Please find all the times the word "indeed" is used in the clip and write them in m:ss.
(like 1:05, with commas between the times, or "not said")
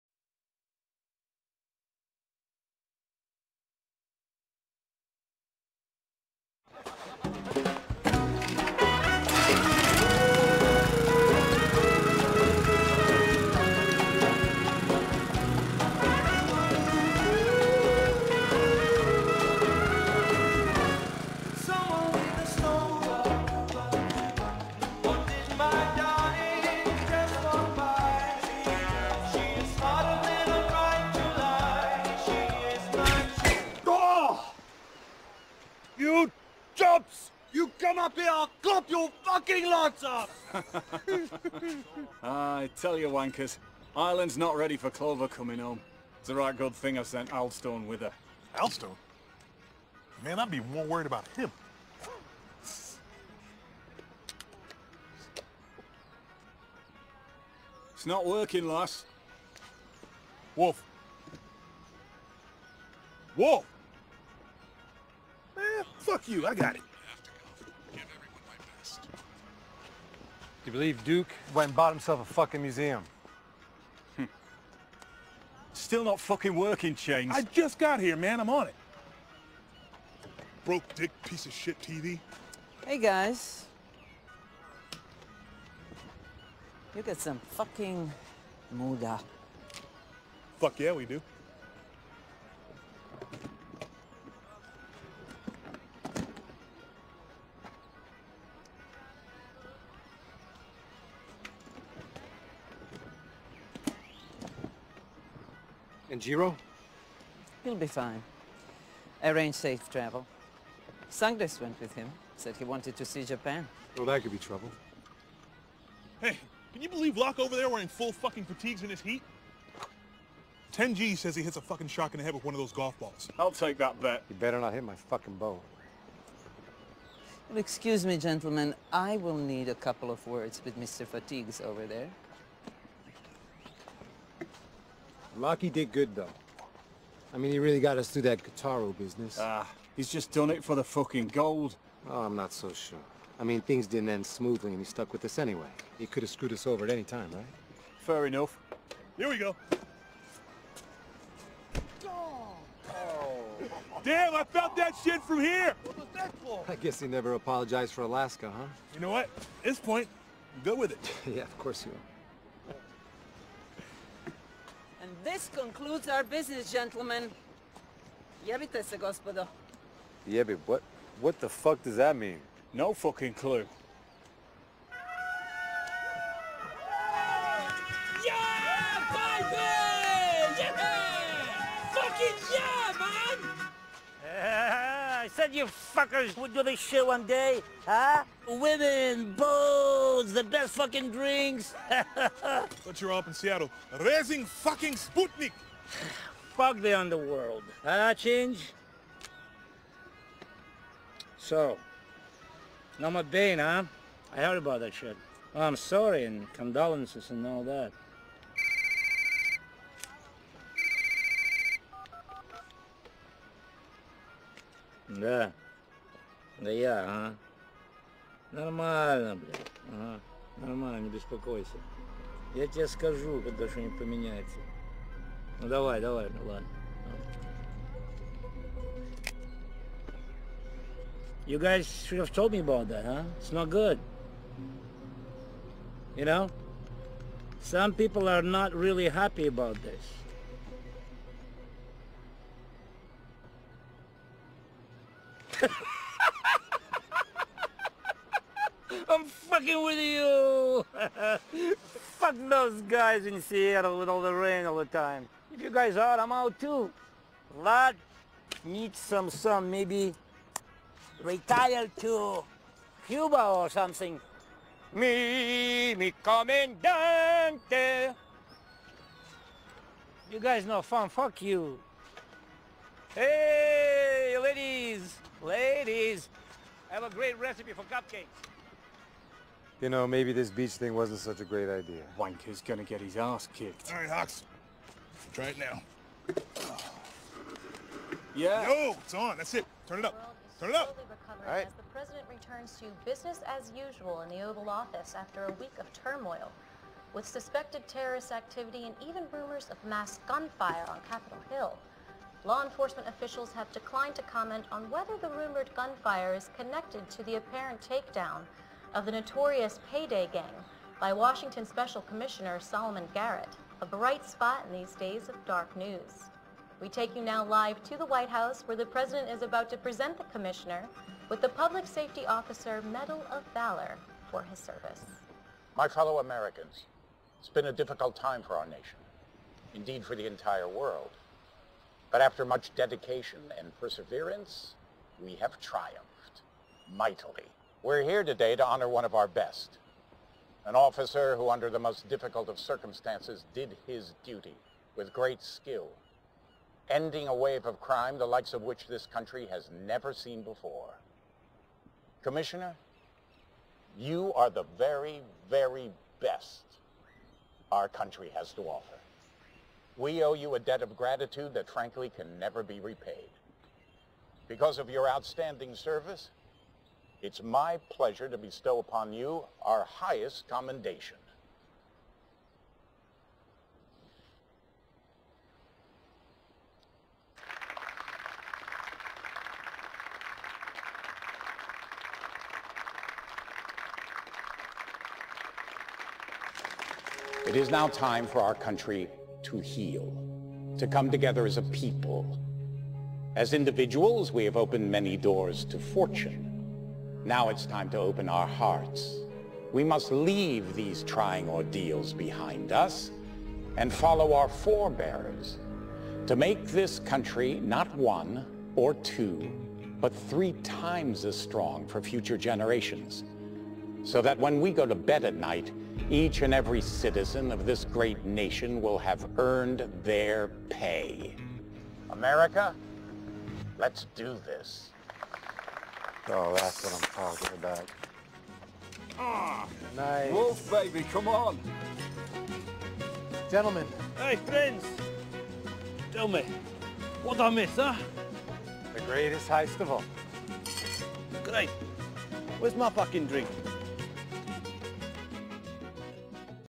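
5:29.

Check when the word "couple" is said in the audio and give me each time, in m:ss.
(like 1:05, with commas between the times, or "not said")
2:09.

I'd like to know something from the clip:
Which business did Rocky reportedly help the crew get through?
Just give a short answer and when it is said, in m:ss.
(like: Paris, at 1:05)
Kataru, at 2:18.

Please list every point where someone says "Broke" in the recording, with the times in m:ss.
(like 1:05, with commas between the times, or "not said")
1:20.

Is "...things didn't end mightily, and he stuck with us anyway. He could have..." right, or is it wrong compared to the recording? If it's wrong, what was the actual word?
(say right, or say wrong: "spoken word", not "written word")
wrong: "smoothly", not "mightily".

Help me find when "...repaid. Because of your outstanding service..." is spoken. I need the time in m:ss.
6:02.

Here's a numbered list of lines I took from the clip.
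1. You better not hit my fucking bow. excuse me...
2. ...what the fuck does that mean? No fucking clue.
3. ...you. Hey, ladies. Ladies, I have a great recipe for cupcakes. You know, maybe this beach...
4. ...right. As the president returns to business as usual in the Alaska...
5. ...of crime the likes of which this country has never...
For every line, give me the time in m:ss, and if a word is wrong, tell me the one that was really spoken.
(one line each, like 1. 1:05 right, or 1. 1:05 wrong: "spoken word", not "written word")
1. 2:04 right
2. 2:51 right
3. 4:31 right
4. 4:51 wrong: "Oval", not "Alaska"
5. 5:47 right.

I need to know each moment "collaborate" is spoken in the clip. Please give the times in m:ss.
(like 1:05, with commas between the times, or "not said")
not said.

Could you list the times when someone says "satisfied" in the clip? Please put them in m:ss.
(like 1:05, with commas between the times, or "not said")
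not said.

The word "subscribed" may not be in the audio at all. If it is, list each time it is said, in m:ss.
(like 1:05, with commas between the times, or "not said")
not said.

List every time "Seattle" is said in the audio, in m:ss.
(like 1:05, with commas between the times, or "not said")
3:13, 4:13.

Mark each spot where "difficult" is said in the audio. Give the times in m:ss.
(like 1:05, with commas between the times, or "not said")
5:27, 5:42.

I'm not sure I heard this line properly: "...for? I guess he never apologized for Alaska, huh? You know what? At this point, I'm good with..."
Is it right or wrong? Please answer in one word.
right.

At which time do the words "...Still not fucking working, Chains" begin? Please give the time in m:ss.
1:15.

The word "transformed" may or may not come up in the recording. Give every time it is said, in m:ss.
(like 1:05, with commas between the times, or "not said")
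not said.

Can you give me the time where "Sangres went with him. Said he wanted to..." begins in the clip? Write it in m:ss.
1:51.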